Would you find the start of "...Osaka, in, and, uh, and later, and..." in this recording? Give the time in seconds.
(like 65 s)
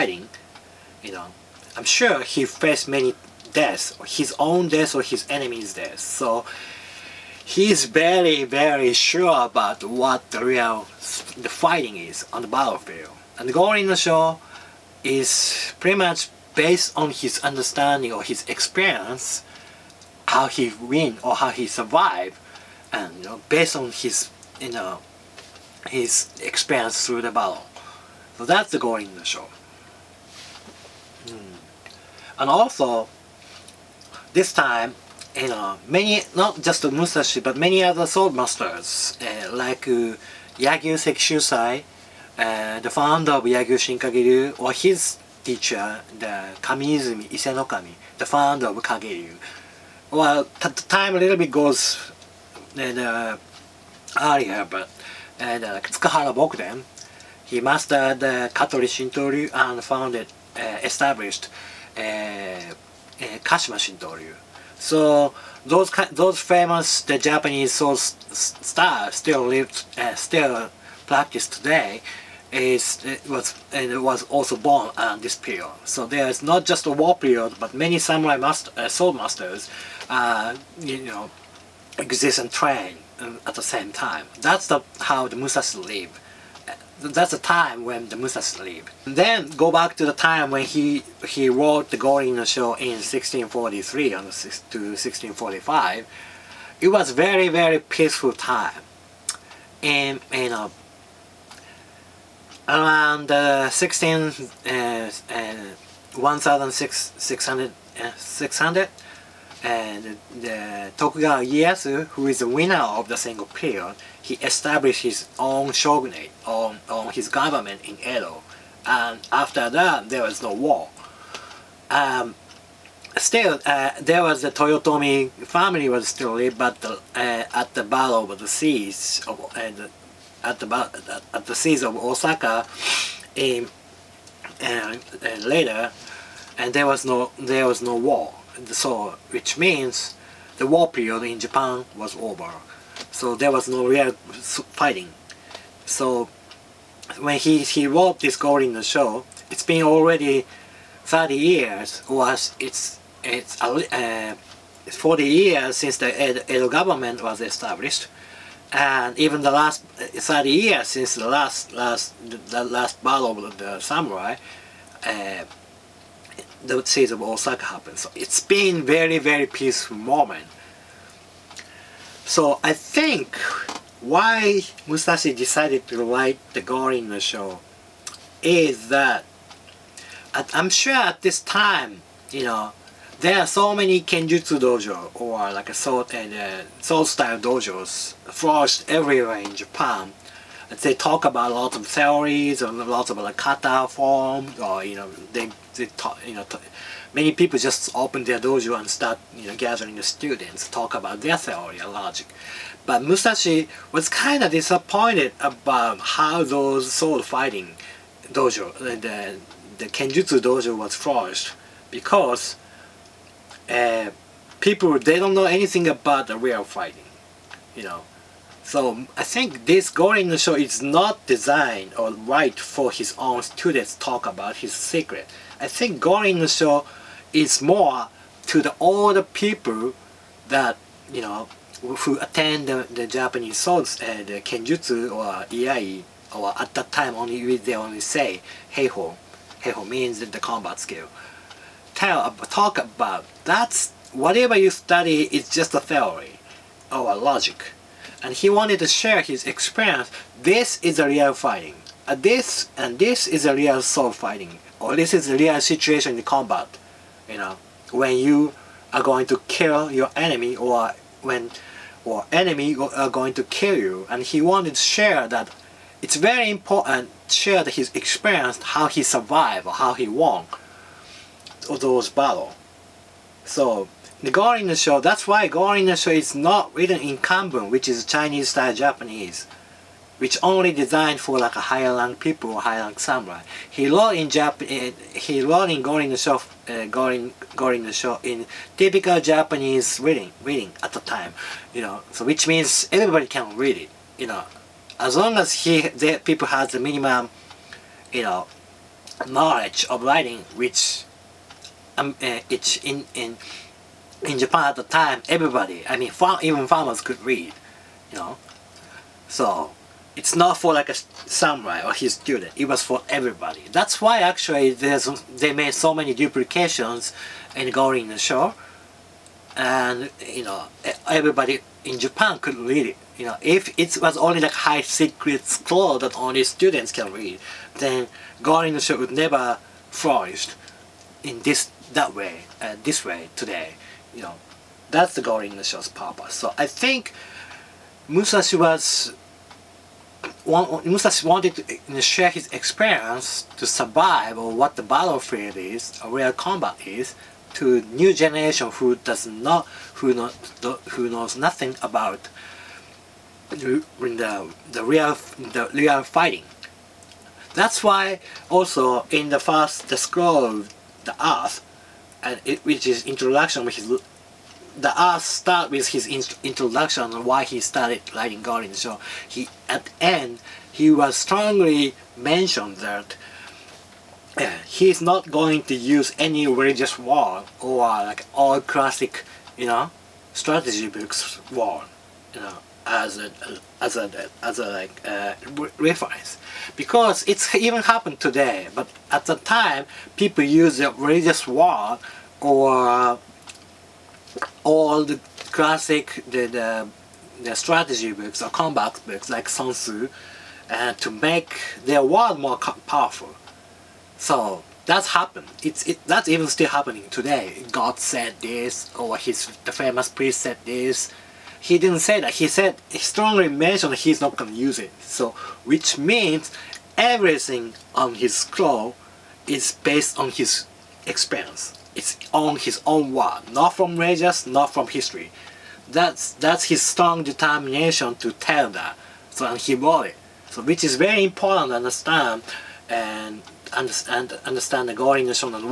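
131 s.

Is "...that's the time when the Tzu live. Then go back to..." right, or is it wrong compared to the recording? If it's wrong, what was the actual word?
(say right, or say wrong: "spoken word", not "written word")
wrong: "Musas", not "Tzu".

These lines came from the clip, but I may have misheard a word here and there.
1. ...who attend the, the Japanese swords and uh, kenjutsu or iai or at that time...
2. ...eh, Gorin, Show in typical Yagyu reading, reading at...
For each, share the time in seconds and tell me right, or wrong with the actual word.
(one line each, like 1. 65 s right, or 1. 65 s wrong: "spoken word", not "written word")
1. 231 s right
2. 286 s wrong: "Japanese", not "Yagyu".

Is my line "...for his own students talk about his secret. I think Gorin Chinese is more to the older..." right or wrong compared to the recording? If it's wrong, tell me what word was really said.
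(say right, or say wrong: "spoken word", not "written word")
wrong: "Sho", not "Chinese".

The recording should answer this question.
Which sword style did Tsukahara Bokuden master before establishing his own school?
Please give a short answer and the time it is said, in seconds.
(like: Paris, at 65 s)
Katori Shintoryu, at 58 s.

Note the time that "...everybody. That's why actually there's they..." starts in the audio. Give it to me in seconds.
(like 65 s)
313 s.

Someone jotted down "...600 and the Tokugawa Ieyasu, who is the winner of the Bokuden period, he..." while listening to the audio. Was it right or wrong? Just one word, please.
wrong.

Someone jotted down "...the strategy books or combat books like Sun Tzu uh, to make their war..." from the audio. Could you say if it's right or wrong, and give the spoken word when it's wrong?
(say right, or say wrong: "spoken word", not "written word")
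right.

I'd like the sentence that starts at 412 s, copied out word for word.
He said, he strongly mentioned he's not going to use it.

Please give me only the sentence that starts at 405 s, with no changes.
It's it, that's even still happening today.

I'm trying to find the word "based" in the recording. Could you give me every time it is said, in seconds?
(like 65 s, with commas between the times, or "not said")
16 s, 23 s, 419 s.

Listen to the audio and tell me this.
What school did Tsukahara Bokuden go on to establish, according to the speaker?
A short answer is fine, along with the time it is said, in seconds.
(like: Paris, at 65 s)
Kashima Shintoryu, at 63 s.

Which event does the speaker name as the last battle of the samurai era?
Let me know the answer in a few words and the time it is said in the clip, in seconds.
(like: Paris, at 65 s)
Siege of Osaka, at 166 s.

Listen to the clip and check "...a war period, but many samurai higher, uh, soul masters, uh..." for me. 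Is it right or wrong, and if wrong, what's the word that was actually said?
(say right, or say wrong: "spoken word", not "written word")
wrong: "master", not "higher".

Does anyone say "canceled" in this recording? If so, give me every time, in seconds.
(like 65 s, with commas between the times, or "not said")
not said.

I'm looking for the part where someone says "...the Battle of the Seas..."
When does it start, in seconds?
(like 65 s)
127 s.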